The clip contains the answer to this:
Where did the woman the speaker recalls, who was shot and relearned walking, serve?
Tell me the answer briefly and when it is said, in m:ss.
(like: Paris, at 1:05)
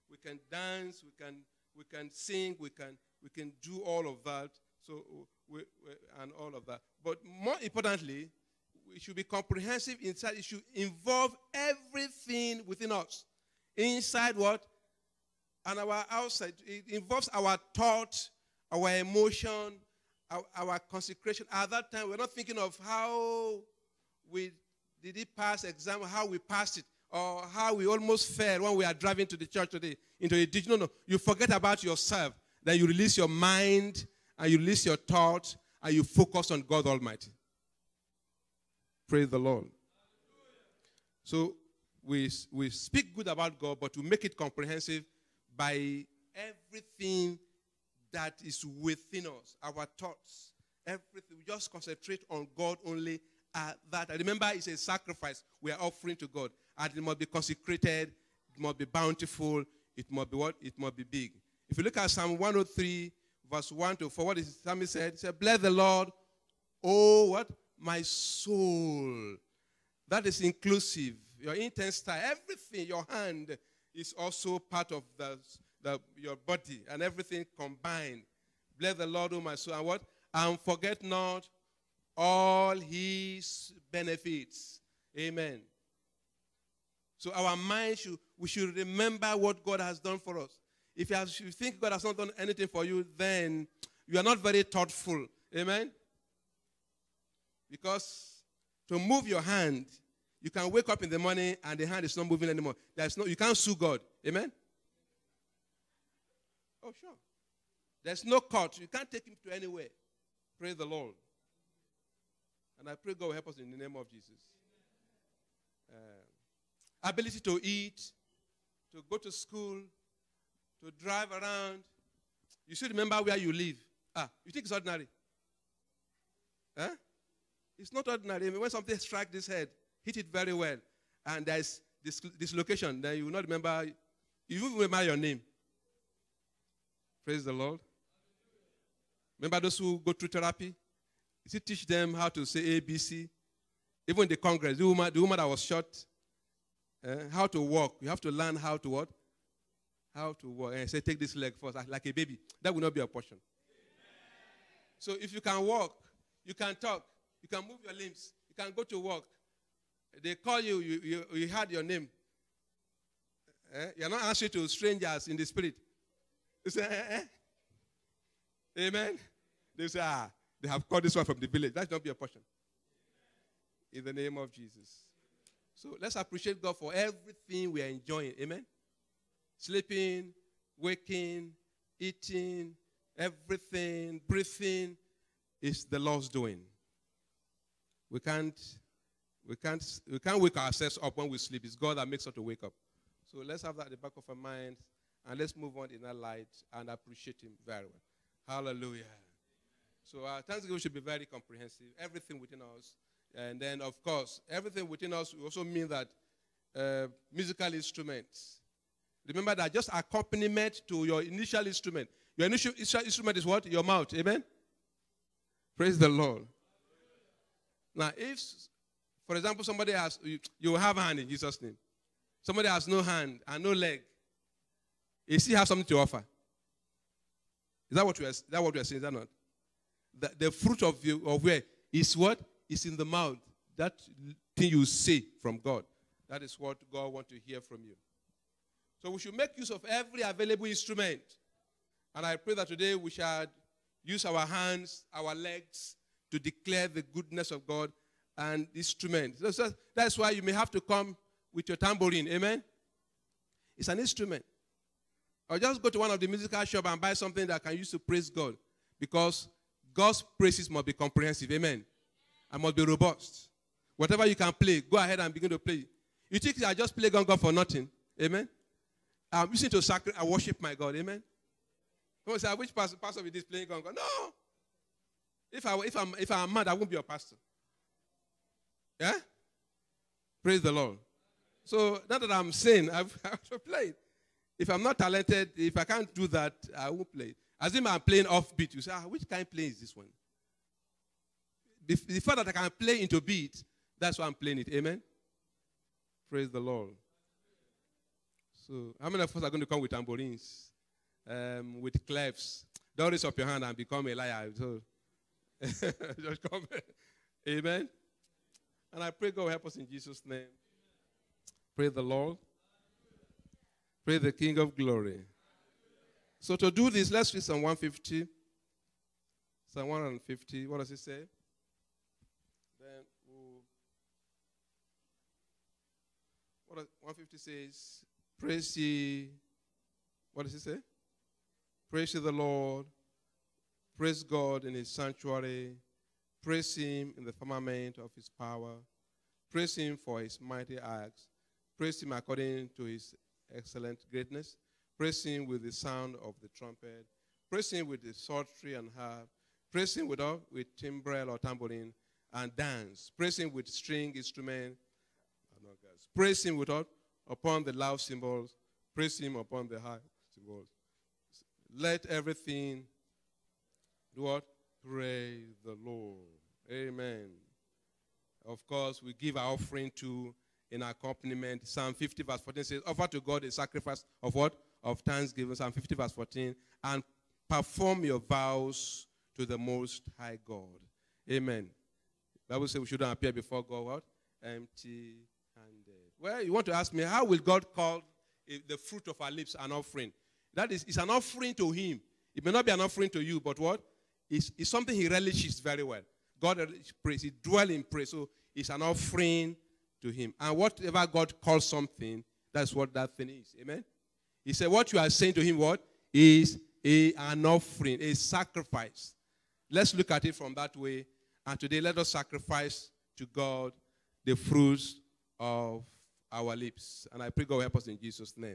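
Congress, at 2:24.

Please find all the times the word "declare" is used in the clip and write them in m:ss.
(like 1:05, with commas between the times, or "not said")
4:06.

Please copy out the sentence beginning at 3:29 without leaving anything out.
Remember that just accompaniment to your initial instrument.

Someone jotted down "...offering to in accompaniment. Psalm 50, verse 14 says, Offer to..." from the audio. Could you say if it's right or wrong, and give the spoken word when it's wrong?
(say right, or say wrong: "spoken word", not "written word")
right.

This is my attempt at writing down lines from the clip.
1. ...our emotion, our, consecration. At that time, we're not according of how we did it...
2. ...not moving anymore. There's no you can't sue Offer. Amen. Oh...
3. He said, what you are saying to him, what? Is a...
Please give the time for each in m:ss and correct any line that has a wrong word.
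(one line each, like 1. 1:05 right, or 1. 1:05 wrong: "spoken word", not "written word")
1. 0:18 wrong: "thinking", not "according"
2. 1:42 wrong: "God", not "Offer"
3. 6:44 right.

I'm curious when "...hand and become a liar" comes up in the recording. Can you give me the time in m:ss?
5:03.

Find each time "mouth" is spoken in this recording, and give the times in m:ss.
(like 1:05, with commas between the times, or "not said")
3:33, 3:53.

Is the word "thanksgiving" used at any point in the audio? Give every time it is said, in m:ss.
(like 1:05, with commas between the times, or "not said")
3:20, 6:14.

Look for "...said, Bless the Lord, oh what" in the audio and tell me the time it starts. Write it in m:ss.
1:05.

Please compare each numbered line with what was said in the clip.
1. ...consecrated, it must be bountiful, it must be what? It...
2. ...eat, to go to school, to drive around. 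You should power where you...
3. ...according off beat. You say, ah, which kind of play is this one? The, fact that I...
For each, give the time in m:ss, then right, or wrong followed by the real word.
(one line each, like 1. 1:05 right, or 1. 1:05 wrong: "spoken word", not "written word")
1. 0:57 right
2. 1:57 wrong: "remember", not "power"
3. 4:47 wrong: "playing", not "according".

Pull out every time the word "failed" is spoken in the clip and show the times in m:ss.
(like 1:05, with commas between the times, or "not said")
0:28.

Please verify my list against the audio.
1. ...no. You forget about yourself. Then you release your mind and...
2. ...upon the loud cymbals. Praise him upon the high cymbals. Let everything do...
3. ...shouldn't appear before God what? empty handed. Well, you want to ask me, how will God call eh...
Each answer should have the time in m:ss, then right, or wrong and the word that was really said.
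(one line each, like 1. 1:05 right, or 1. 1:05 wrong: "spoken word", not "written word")
1. 0:30 right
2. 5:57 right
3. 6:22 right.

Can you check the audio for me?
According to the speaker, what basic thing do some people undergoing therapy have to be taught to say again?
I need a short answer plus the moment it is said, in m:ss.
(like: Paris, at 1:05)
ABC, at 2:22.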